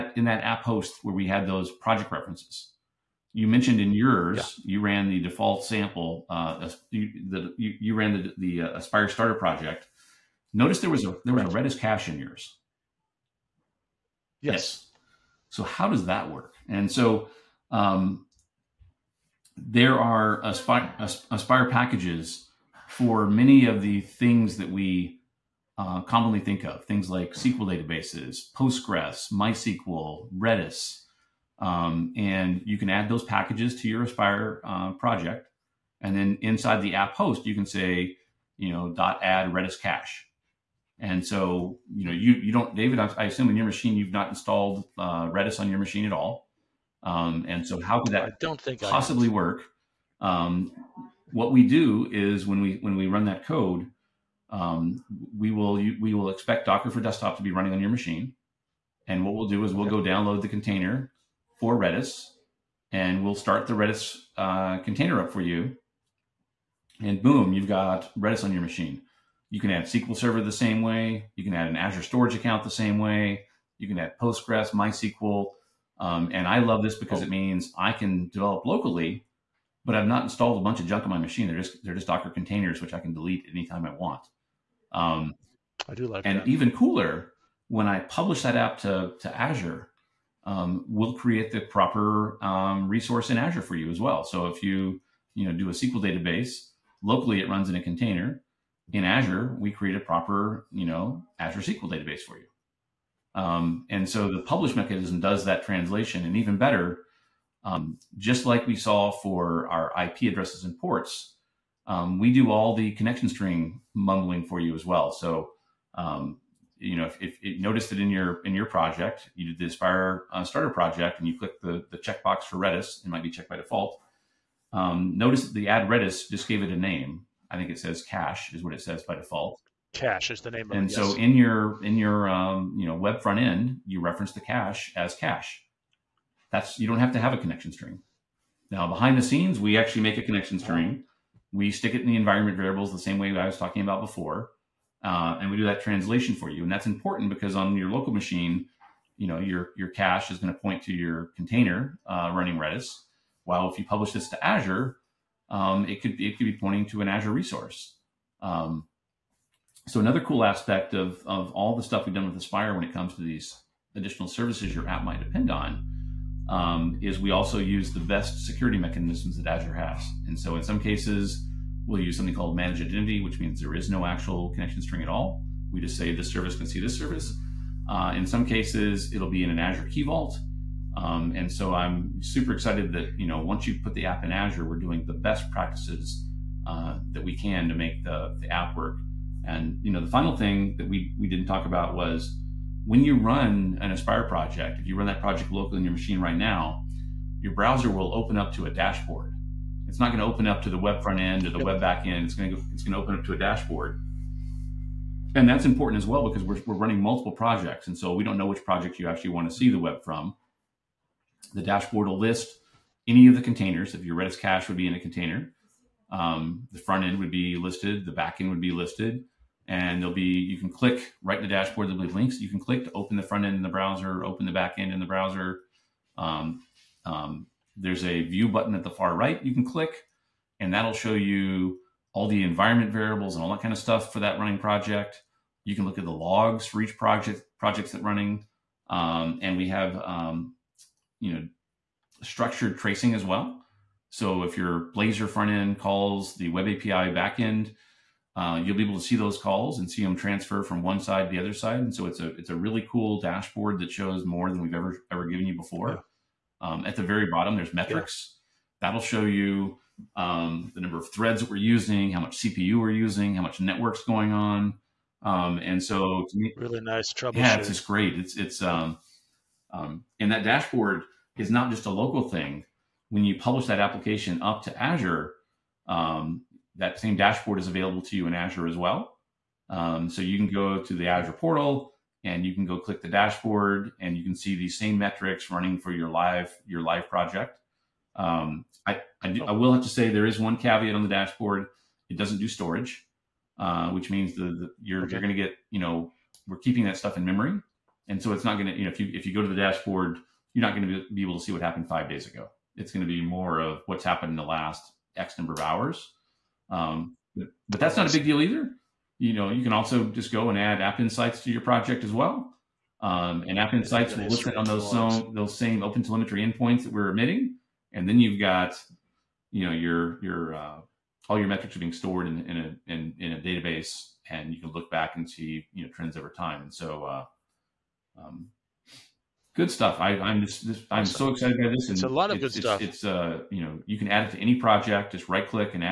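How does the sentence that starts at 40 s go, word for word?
And so, you know, you you don't, David.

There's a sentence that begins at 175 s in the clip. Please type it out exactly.
We just say this service can see this service.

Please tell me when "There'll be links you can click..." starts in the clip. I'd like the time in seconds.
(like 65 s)
221 s.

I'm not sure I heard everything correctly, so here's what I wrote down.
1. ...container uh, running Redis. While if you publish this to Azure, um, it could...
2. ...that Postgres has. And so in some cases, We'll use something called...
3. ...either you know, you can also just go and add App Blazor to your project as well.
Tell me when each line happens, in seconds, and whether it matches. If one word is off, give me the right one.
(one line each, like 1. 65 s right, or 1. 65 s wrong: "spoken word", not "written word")
1. 151 s right
2. 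169 s wrong: "Azure", not "Postgres"
3. 308 s wrong: "Insights", not "Blazor".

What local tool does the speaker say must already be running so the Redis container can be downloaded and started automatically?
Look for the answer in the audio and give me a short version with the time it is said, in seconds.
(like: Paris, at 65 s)
Docker for Desktop, at 56 s.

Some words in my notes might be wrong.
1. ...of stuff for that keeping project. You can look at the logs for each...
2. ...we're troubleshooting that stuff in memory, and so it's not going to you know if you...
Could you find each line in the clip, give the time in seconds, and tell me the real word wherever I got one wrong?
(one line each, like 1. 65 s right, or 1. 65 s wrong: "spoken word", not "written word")
1. 233 s wrong: "running", not "keeping"
2. 296 s wrong: "keeping", not "troubleshooting".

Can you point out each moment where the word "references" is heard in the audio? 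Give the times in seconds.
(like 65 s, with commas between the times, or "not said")
2 s, 133 s.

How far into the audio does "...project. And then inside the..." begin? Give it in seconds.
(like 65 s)
34 s.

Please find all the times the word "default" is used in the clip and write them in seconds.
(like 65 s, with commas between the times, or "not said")
5 s, 123 s, 129 s.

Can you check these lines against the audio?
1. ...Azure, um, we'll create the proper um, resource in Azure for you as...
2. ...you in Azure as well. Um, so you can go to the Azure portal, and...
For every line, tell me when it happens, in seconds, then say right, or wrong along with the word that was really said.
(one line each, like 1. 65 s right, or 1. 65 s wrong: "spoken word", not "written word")
1. 89 s right
2. 278 s right.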